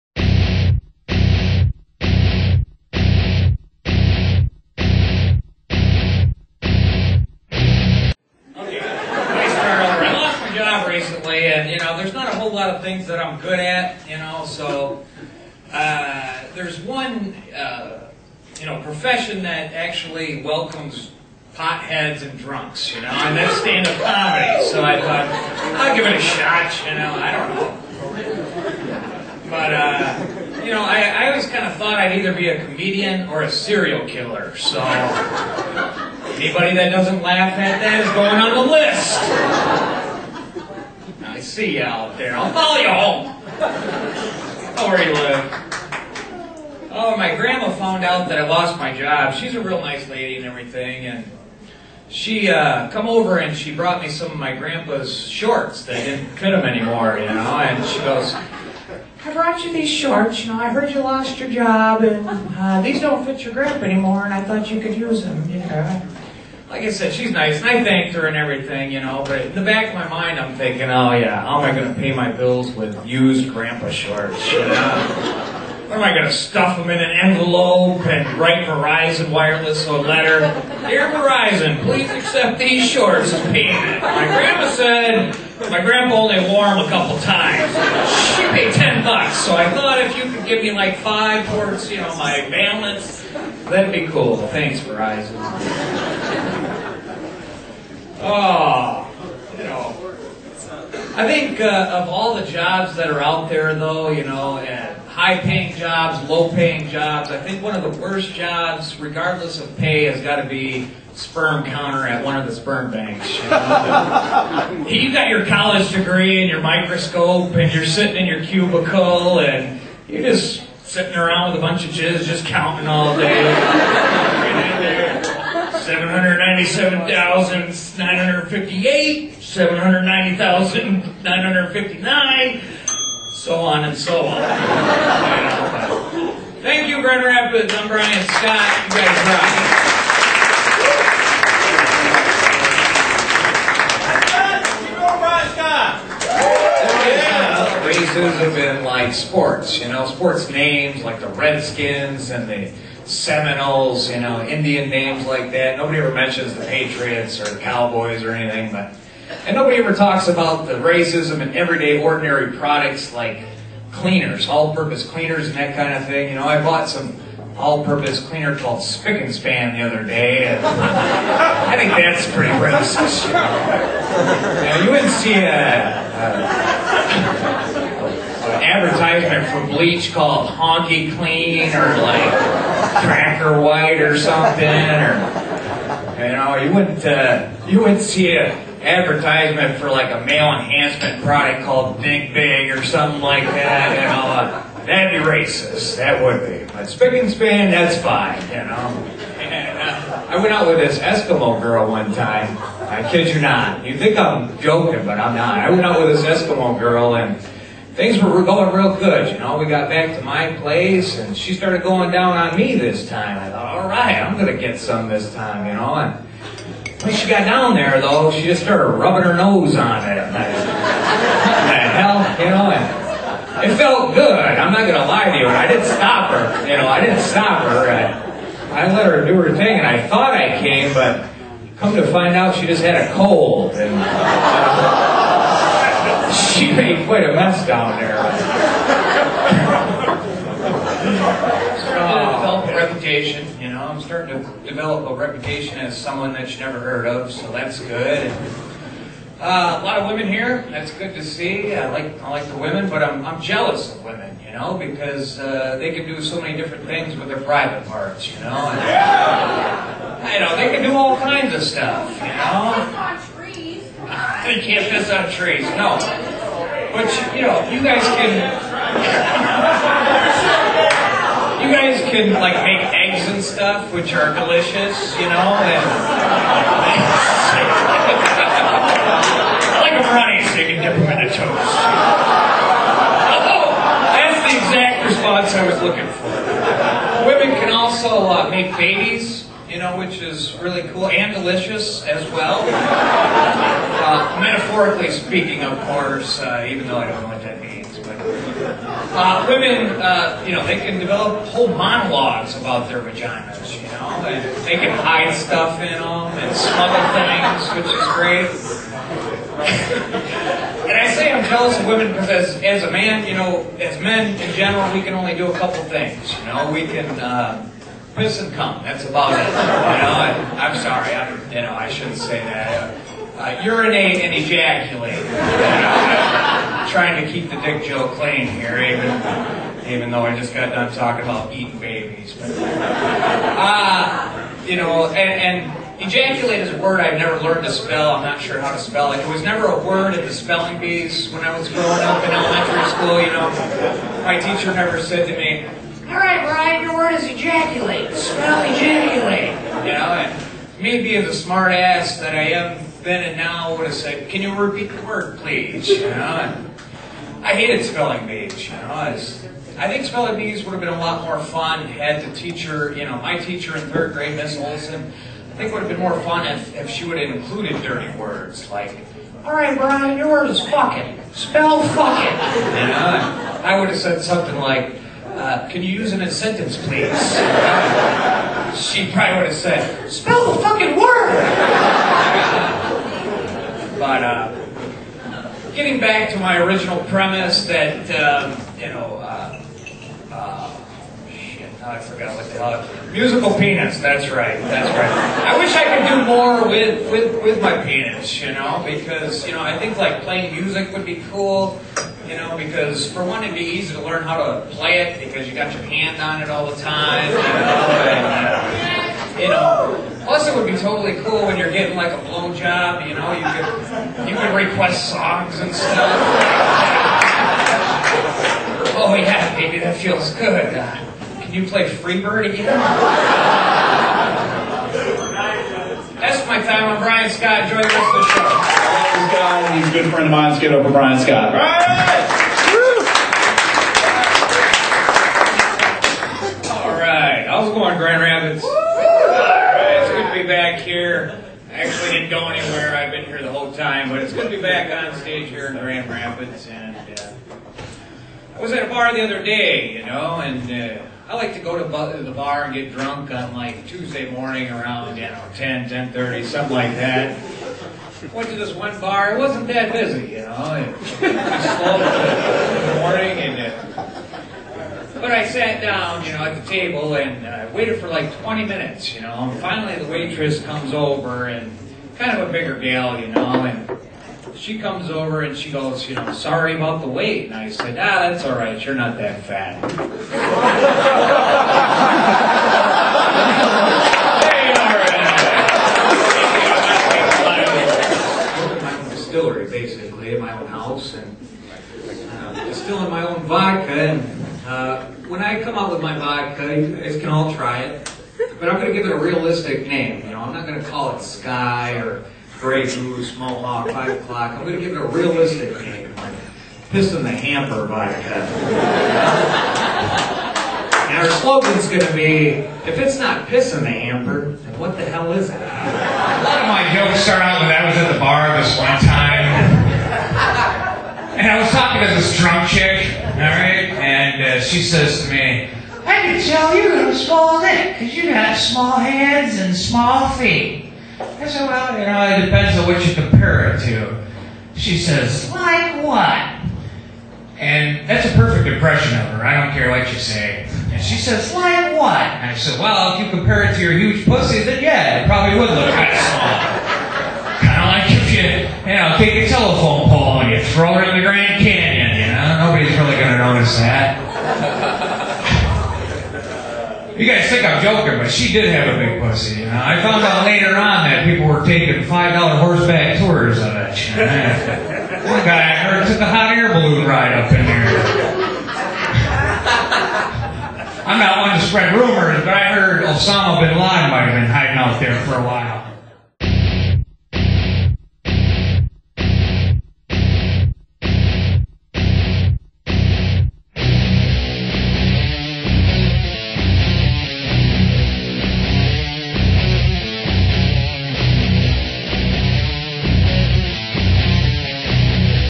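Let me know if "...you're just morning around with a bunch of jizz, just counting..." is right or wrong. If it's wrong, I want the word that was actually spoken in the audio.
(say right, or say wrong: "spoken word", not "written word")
wrong: "sitting", not "morning".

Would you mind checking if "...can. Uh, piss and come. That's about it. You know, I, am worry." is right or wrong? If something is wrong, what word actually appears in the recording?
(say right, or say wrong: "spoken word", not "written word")
wrong: "sorry", not "worry".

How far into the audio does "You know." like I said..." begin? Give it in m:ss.
1:05.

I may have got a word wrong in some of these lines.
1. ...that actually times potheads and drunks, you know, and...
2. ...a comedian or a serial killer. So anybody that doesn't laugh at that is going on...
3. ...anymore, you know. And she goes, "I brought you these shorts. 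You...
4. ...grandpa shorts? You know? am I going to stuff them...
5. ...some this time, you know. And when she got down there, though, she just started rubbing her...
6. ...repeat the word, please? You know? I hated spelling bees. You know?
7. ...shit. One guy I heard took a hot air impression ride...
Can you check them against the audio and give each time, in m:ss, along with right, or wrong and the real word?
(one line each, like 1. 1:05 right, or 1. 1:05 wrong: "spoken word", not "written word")
1. 0:19 wrong: "welcomes", not "times"
2. 0:32 right
3. 0:56 right
4. 1:13 right
5. 3:34 right
6. 5:54 right
7. 9:23 wrong: "balloon", not "impression".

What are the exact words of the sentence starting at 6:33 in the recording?
Musical penis, that's right, that's right.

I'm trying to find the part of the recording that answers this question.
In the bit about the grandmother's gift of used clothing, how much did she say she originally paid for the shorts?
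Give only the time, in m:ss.
1:28.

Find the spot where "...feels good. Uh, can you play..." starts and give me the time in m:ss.
6:59.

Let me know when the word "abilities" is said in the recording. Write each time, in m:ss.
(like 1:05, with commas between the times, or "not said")
not said.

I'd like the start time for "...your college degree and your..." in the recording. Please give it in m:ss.
1:55.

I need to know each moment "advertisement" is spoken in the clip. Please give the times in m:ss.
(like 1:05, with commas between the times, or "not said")
2:58, 3:08.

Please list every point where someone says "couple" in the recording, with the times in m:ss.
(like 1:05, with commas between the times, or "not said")
1:26, 5:15.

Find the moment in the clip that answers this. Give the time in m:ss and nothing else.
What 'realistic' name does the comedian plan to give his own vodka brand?
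8:26.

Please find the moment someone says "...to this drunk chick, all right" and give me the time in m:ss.
8:42.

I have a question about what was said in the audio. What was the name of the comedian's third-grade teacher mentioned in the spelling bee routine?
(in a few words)
Miss Olson.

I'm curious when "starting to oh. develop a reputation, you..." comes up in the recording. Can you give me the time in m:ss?
3:59.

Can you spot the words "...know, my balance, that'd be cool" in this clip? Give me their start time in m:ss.
1:31.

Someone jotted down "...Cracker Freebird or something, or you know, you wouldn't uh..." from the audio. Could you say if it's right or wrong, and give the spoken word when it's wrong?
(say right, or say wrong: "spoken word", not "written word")
wrong: "White", not "Freebird".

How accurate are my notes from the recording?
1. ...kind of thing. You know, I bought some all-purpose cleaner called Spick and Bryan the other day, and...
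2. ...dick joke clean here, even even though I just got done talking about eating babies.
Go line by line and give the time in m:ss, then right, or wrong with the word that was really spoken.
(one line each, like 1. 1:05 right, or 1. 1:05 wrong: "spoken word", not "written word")
1. 2:45 wrong: "Span", not "Bryan"
2. 5:27 right.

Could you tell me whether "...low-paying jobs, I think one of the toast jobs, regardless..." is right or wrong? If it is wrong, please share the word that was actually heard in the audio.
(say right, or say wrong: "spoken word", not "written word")
wrong: "worst", not "toast".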